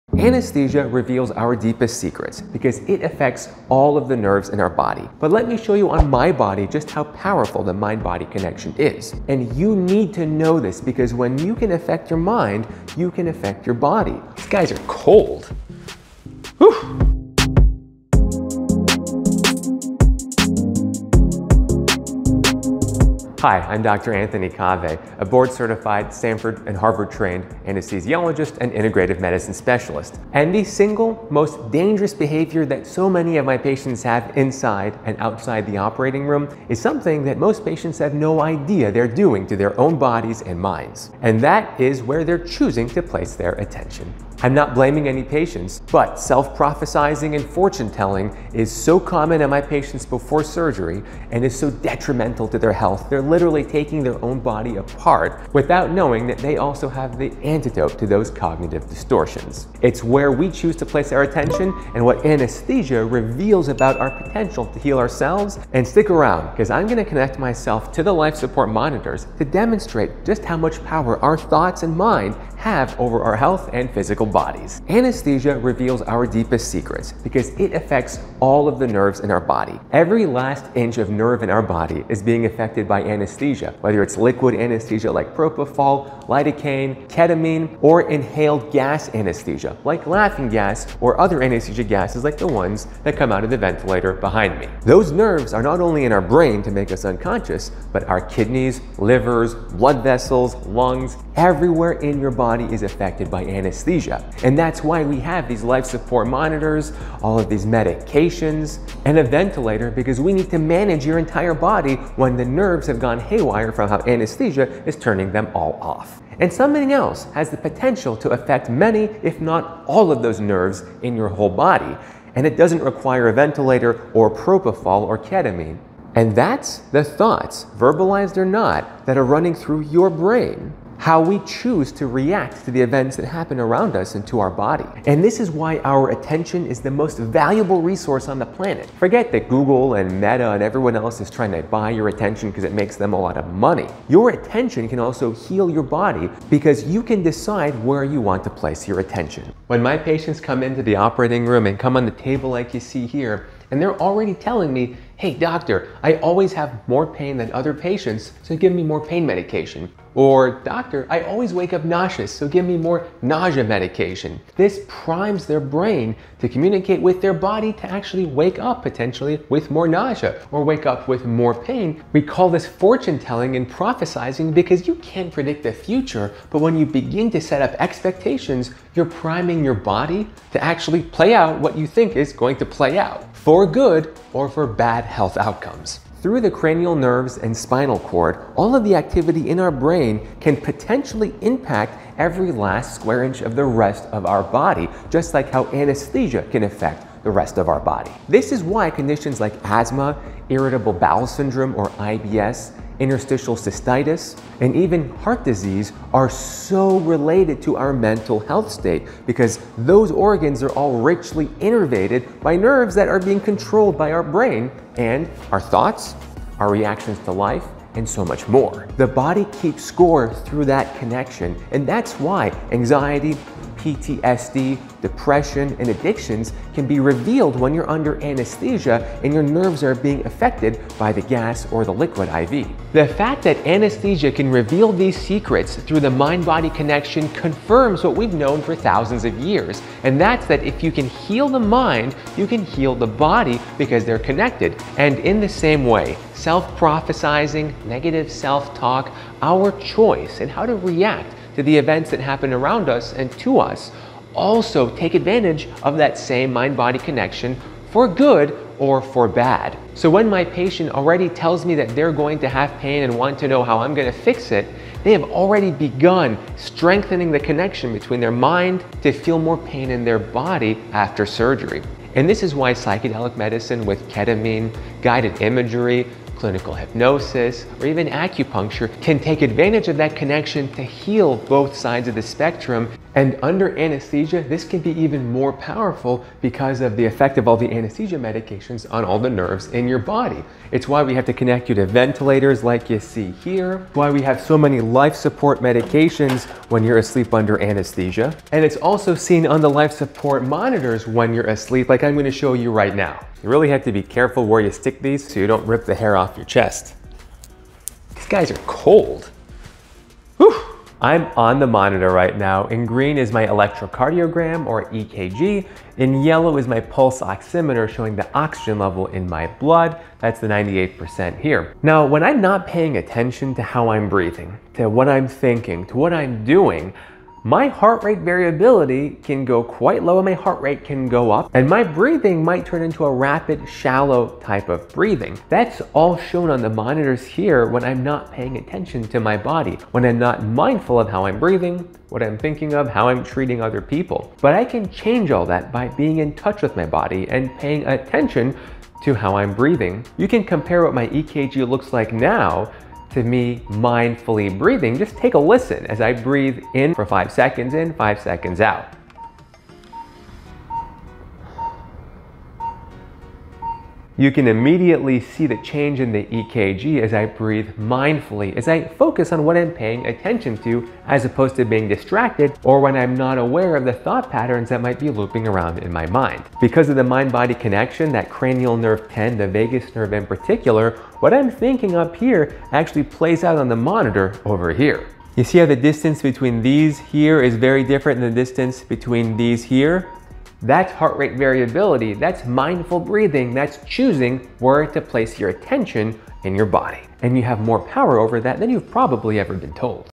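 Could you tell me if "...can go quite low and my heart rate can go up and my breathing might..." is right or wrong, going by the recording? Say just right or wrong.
right.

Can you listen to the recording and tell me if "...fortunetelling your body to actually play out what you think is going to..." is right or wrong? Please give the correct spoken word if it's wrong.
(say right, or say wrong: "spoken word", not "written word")
wrong: "priming", not "fortunetelling".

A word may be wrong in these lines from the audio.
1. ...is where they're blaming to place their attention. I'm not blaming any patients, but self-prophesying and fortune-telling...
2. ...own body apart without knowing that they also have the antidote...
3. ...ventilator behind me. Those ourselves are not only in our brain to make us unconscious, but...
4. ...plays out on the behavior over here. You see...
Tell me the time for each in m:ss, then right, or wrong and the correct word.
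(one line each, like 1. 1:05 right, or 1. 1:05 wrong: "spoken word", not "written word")
1. 0:41 wrong: "choosing", not "blaming"
2. 0:54 right
3. 1:33 wrong: "nerves", not "ourselves"
4. 6:23 wrong: "monitor", not "behavior".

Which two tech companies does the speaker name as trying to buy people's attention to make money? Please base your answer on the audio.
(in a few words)
Google and Meta.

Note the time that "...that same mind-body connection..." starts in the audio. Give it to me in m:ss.
4:15.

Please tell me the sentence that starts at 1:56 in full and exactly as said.
And something else has the potential to affect many, if not all of those nerves in your whole body.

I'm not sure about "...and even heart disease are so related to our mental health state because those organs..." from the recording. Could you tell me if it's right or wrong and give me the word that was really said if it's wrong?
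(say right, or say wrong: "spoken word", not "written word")
right.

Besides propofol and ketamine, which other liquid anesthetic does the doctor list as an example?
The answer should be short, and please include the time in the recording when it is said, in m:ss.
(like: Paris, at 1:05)
lidocaine, at 1:26.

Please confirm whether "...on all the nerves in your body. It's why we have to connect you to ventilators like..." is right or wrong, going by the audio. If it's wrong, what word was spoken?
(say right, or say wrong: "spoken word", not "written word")
right.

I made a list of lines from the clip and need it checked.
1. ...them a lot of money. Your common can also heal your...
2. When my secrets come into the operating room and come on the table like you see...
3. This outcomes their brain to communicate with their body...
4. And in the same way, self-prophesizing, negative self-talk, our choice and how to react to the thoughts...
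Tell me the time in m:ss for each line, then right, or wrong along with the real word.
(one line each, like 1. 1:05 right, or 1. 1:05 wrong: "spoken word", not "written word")
1. 2:22 wrong: "attention", not "common"
2. 2:29 wrong: "patients", not "secrets"
3. 2:44 wrong: "primes", not "outcomes"
4. 4:04 wrong: "events", not "thoughts".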